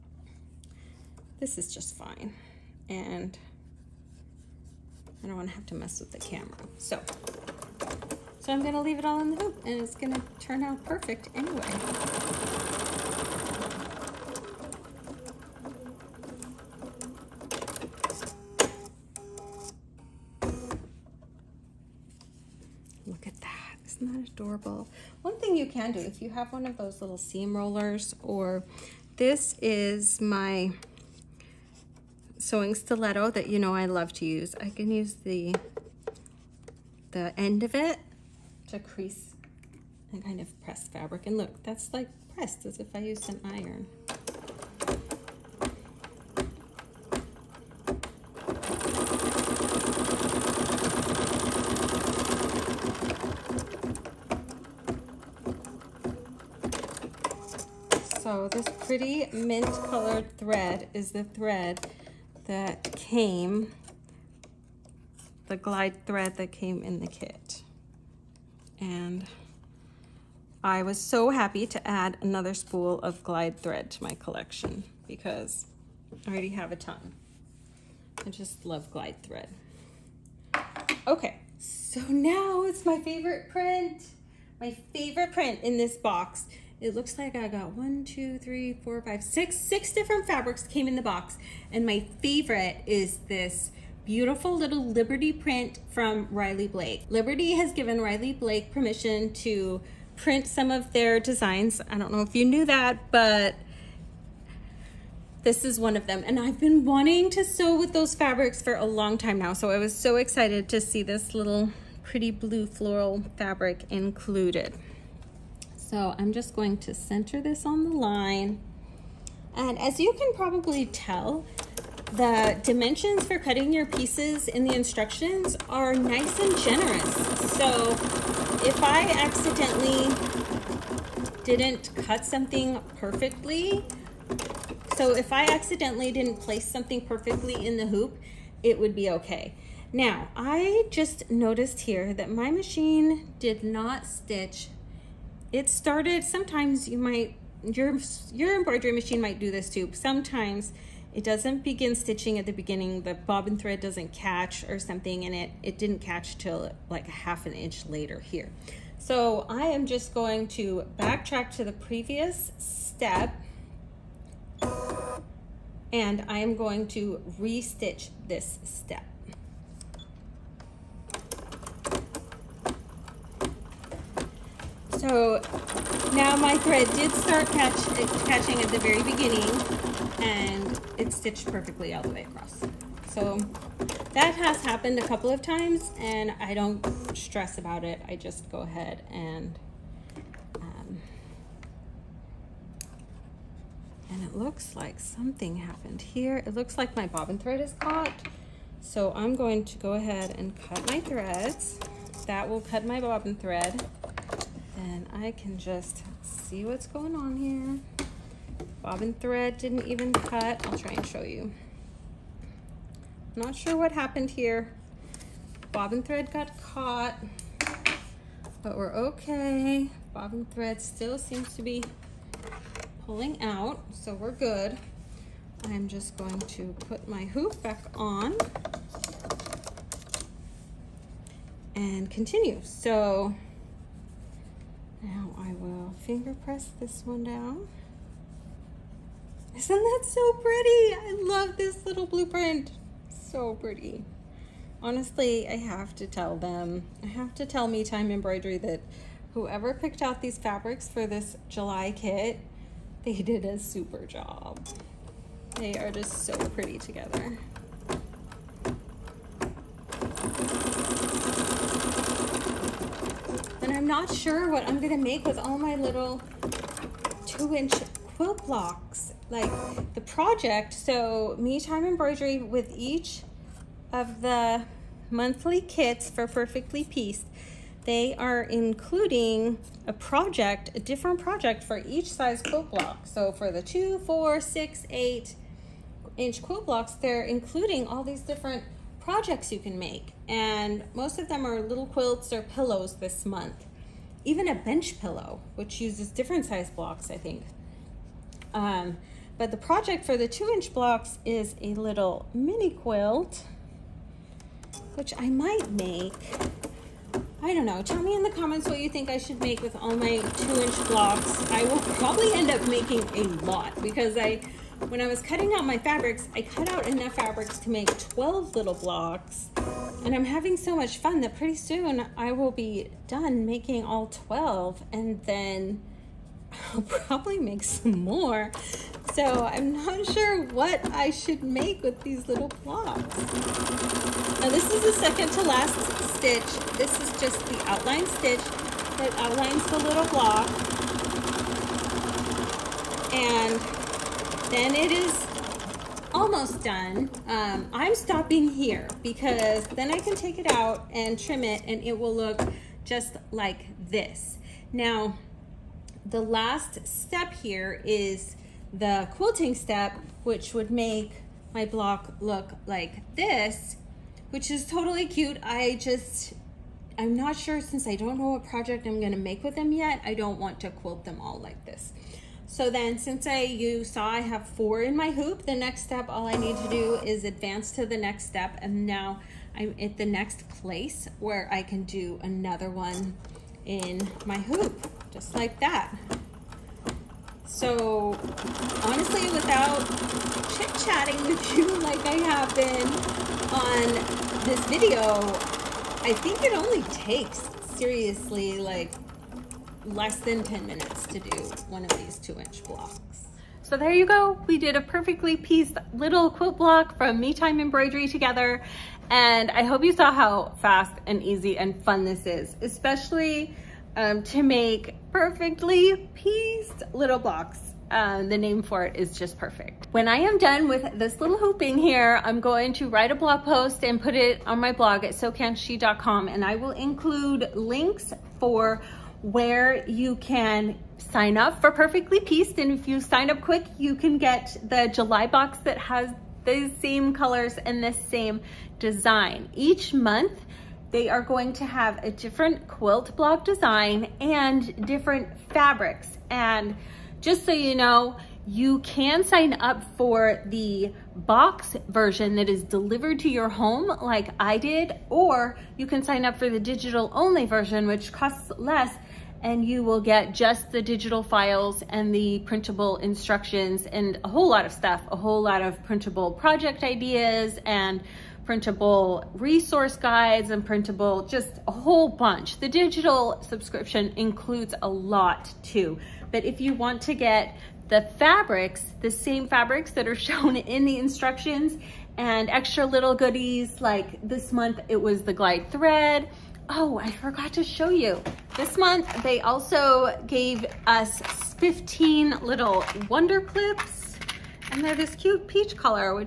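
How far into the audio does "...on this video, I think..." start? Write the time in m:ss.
6:33.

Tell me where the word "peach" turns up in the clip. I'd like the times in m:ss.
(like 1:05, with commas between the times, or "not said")
8:15.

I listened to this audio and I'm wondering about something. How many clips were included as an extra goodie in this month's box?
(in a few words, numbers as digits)
15.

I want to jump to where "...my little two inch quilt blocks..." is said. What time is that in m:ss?
4:25.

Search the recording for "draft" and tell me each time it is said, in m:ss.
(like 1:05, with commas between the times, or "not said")
not said.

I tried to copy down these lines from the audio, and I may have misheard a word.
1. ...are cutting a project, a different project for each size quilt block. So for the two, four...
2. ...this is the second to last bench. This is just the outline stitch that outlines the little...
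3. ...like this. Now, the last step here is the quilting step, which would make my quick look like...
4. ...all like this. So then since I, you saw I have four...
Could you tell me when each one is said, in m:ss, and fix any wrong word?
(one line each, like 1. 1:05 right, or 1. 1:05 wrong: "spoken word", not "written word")
1. 4:38 wrong: "including", not "cutting"
2. 5:34 wrong: "stitch", not "bench"
3. 5:53 wrong: "block", not "quick"
4. 6:11 right.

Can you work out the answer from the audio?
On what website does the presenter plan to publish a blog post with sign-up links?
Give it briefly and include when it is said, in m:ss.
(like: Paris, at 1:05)
SewCanShe.com, at 7:05.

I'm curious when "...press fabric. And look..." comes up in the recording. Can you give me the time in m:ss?
0:40.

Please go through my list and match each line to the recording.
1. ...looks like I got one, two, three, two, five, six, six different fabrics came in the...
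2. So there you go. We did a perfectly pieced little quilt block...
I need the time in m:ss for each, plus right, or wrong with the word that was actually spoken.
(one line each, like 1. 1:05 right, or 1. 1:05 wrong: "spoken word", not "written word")
1. 1:26 wrong: "four", not "two"
2. 6:43 right.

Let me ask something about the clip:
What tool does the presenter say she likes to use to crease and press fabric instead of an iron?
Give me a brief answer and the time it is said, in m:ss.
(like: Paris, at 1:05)
sewing stiletto, at 0:32.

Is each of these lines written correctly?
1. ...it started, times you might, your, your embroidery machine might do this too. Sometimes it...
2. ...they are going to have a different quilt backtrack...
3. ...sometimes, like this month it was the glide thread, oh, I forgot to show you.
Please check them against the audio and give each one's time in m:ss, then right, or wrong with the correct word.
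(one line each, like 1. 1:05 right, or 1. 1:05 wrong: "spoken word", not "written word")
1. 2:25 wrong: "sometimes", not "times"
2. 7:20 wrong: "block", not "backtrack"
3. 8:03 wrong: "goodies", not "sometimes".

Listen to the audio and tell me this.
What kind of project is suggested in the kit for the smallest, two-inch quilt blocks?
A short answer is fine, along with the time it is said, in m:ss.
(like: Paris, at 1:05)
mini quilt, at 5:02.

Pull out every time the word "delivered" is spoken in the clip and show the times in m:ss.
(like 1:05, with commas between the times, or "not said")
7:32.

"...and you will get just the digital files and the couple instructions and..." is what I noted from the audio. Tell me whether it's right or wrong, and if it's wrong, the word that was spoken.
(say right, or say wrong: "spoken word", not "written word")
wrong: "printable", not "couple".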